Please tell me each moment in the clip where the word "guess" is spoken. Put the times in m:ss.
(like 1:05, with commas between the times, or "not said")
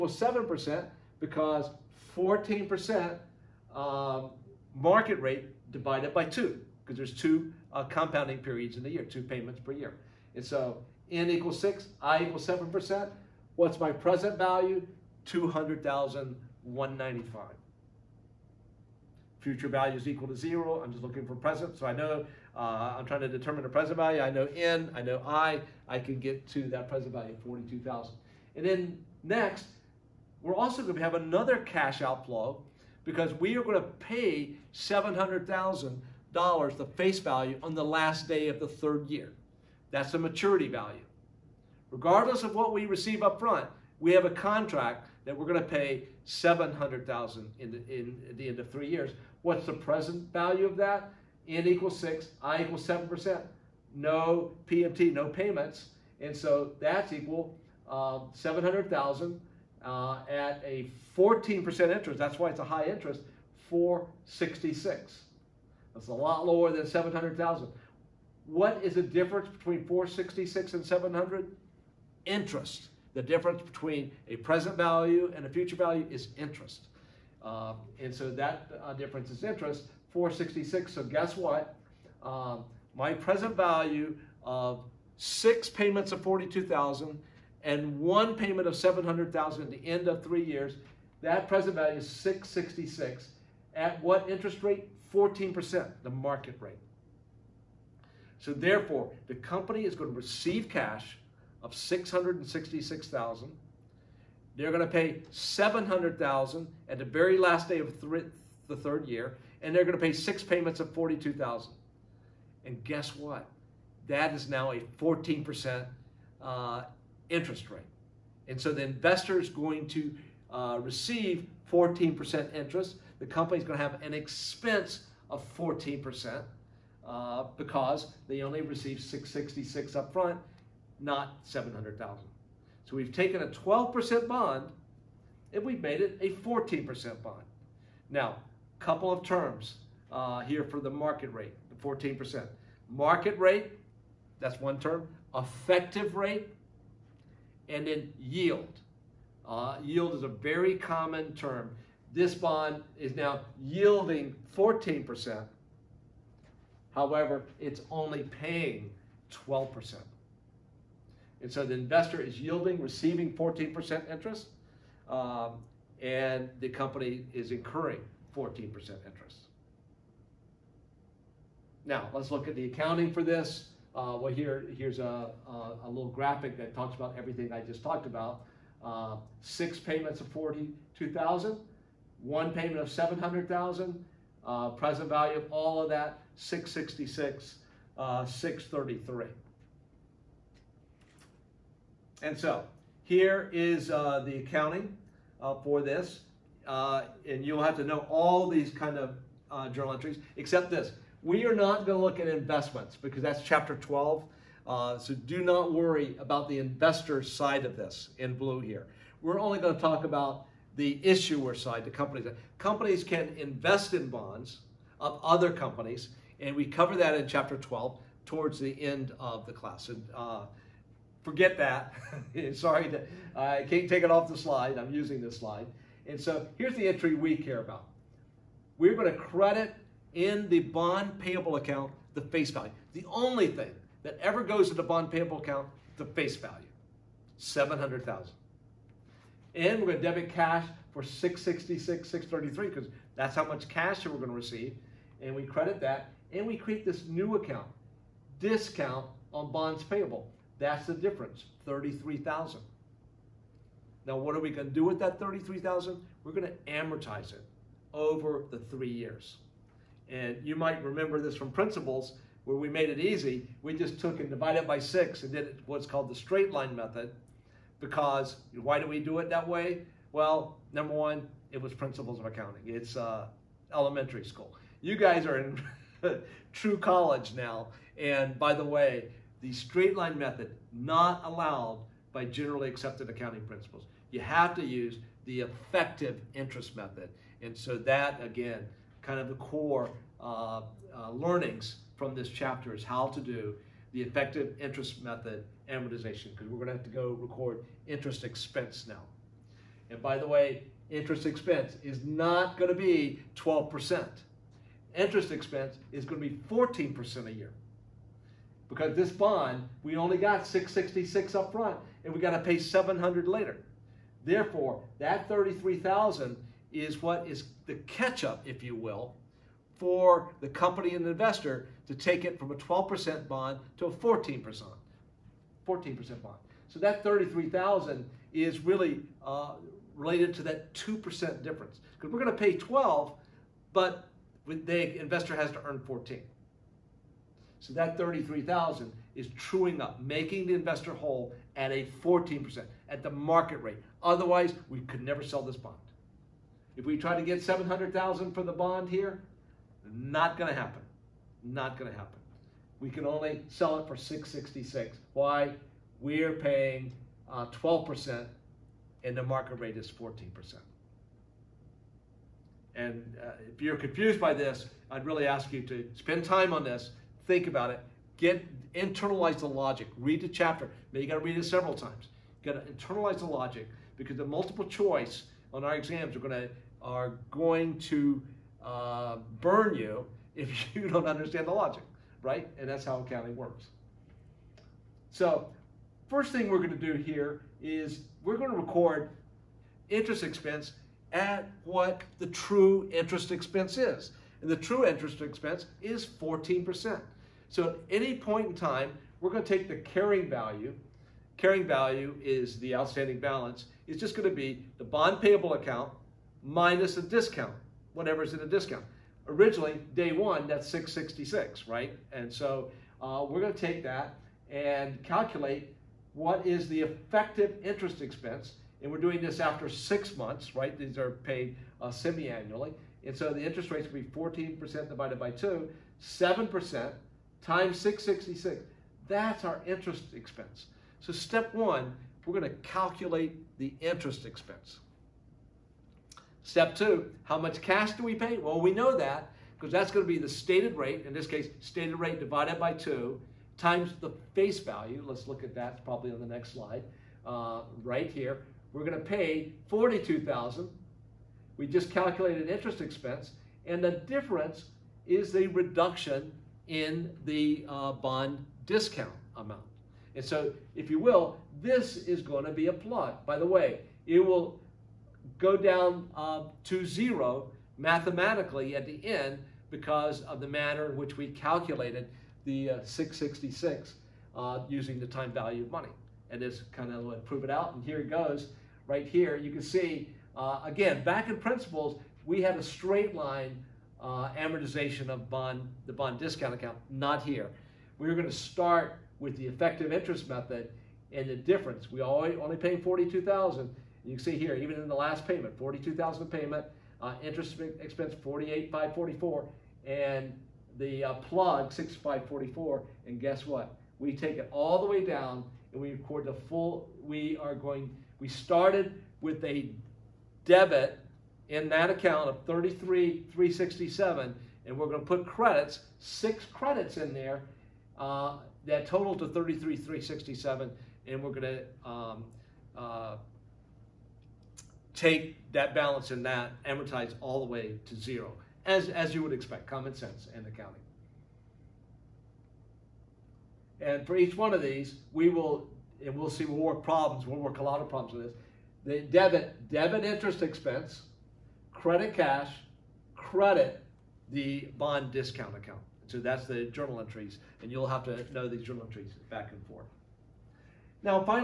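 1:21, 1:52, 8:23.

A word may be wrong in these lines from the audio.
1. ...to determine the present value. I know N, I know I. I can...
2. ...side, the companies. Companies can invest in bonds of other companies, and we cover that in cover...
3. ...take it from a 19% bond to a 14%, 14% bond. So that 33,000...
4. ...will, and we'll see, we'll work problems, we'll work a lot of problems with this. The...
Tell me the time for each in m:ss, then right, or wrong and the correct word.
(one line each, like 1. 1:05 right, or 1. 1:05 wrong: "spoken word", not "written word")
1. 0:23 right
2. 3:31 wrong: "chapter", not "cover"
3. 5:21 wrong: "12", not "19"
4. 8:55 right.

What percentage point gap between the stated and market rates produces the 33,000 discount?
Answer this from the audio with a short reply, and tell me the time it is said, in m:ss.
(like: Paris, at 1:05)
2%, at 5:30.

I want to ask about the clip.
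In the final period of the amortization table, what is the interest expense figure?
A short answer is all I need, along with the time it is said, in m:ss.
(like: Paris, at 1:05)
48,544, at 8:18.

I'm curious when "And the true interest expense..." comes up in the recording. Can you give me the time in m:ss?
6:34.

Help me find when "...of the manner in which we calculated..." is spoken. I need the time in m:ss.
7:50.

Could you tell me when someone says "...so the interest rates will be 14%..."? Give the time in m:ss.
7:03.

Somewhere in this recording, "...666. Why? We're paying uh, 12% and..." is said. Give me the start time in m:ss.
5:53.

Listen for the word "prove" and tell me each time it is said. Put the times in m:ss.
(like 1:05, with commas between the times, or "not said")
7:57.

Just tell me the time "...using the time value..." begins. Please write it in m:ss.
7:54.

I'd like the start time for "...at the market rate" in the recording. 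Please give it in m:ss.
5:42.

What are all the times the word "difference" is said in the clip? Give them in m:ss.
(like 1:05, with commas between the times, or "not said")
1:09, 1:13, 1:18, 4:10, 5:31, 7:33, 8:11.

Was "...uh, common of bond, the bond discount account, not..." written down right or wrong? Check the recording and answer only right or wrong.
wrong.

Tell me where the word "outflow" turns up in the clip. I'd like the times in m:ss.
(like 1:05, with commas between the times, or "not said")
0:32.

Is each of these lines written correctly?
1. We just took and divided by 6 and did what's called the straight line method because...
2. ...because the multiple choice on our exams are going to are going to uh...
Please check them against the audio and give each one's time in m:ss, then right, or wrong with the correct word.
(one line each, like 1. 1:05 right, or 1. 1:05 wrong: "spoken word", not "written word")
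1. 4:23 right
2. 6:13 right.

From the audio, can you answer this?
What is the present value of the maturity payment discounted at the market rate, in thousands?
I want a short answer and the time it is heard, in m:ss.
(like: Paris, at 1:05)
466, at 1:02.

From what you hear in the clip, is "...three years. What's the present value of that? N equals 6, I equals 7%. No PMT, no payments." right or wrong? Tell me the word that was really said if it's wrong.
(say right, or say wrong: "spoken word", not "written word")
right.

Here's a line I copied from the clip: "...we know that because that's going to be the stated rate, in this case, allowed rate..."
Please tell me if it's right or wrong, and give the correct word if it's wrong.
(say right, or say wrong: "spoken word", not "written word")
wrong: "stated", not "allowed".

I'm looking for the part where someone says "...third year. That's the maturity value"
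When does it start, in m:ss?
0:38.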